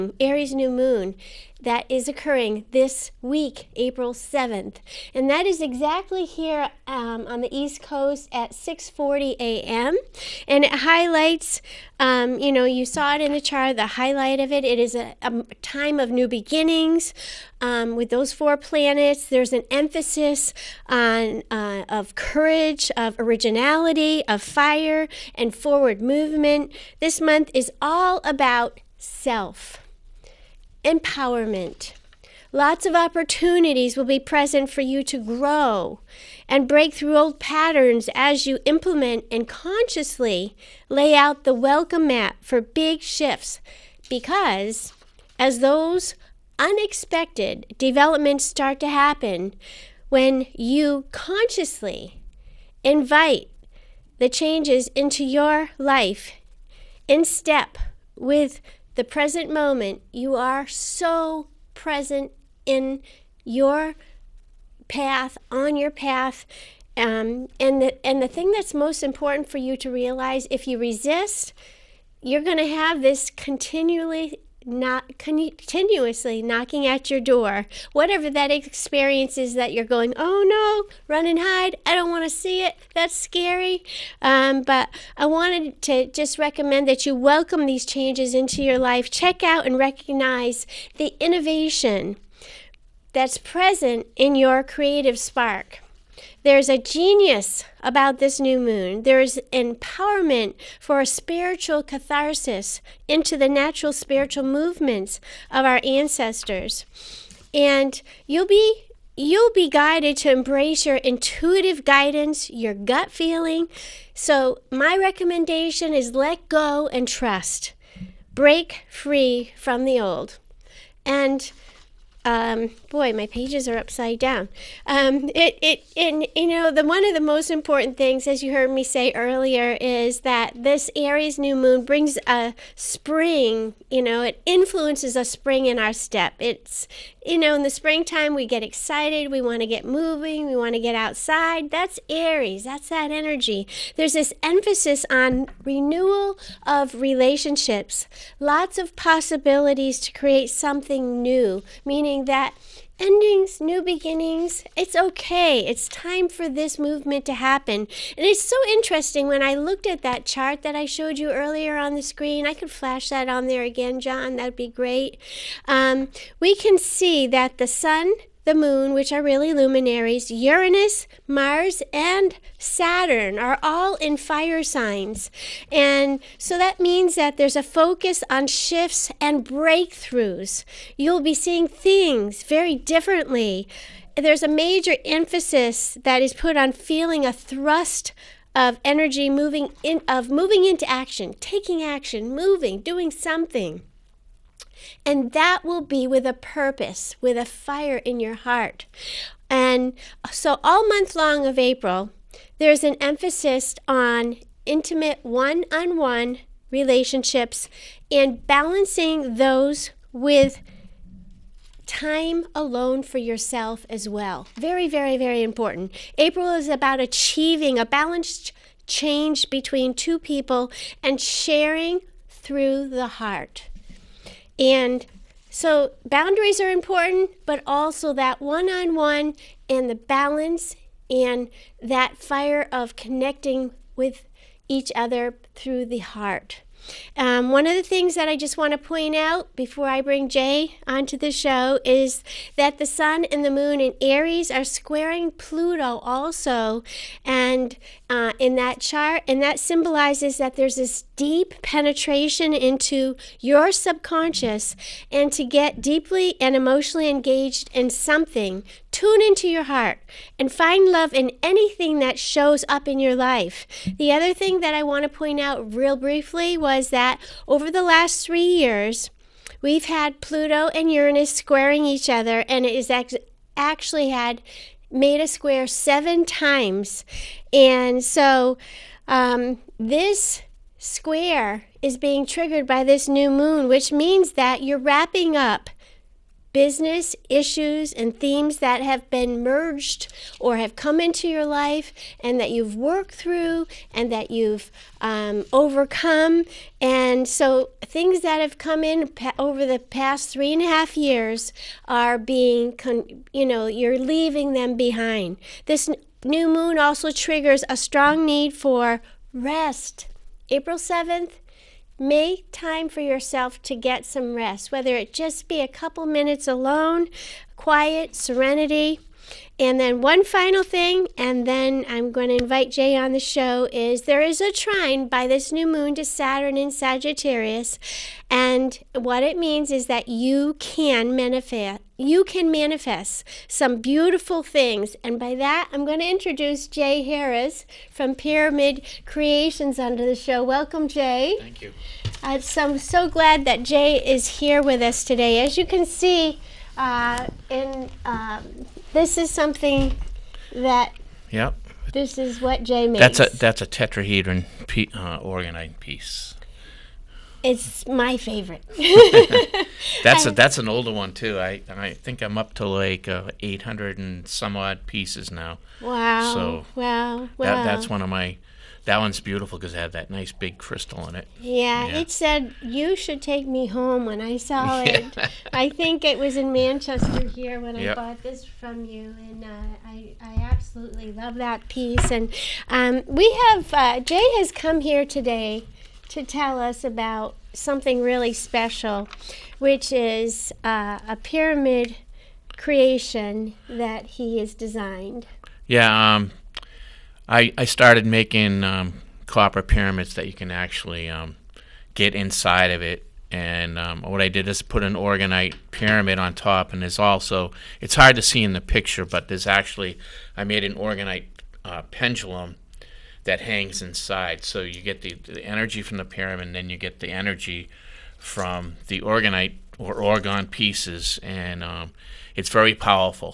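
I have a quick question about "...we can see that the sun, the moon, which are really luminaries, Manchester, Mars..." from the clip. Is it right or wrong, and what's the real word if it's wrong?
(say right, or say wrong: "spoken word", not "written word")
wrong: "Uranus", not "Manchester".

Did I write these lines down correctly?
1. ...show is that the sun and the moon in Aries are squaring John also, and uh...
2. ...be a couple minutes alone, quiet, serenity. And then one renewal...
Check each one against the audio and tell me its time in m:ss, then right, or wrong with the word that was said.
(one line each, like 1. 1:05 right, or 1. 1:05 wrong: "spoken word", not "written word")
1. 4:01 wrong: "Pluto", not "John"
2. 5:15 wrong: "final", not "renewal".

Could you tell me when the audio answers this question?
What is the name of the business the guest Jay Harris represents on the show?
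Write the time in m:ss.
5:38.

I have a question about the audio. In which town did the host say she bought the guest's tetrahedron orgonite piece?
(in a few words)
Manchester.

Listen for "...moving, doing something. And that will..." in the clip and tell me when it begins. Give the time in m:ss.
3:12.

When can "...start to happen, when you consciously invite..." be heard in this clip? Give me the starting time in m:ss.
0:48.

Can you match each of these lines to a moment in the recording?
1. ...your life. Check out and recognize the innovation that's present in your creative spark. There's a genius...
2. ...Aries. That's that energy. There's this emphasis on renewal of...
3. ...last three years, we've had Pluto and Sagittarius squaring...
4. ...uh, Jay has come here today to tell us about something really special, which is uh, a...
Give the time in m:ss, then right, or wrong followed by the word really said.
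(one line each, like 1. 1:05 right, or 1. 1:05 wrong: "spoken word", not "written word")
1. 1:28 right
2. 2:22 right
3. 4:27 wrong: "Uranus", not "Sagittarius"
4. 6:23 right.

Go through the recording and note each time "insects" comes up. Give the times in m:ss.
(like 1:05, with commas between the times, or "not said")
not said.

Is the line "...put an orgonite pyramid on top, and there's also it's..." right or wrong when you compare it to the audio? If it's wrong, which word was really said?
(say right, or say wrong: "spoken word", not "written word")
right.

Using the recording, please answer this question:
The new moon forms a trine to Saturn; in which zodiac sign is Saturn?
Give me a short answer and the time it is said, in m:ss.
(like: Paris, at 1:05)
Sagittarius, at 5:26.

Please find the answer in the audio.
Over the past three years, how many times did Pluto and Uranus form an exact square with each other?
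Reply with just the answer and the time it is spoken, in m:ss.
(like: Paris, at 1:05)
7, at 4:35.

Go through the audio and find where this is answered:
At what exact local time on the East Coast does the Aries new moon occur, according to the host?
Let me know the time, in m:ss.
0:08.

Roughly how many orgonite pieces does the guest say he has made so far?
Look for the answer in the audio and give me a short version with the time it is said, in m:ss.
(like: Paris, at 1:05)
800 and some, at 6:03.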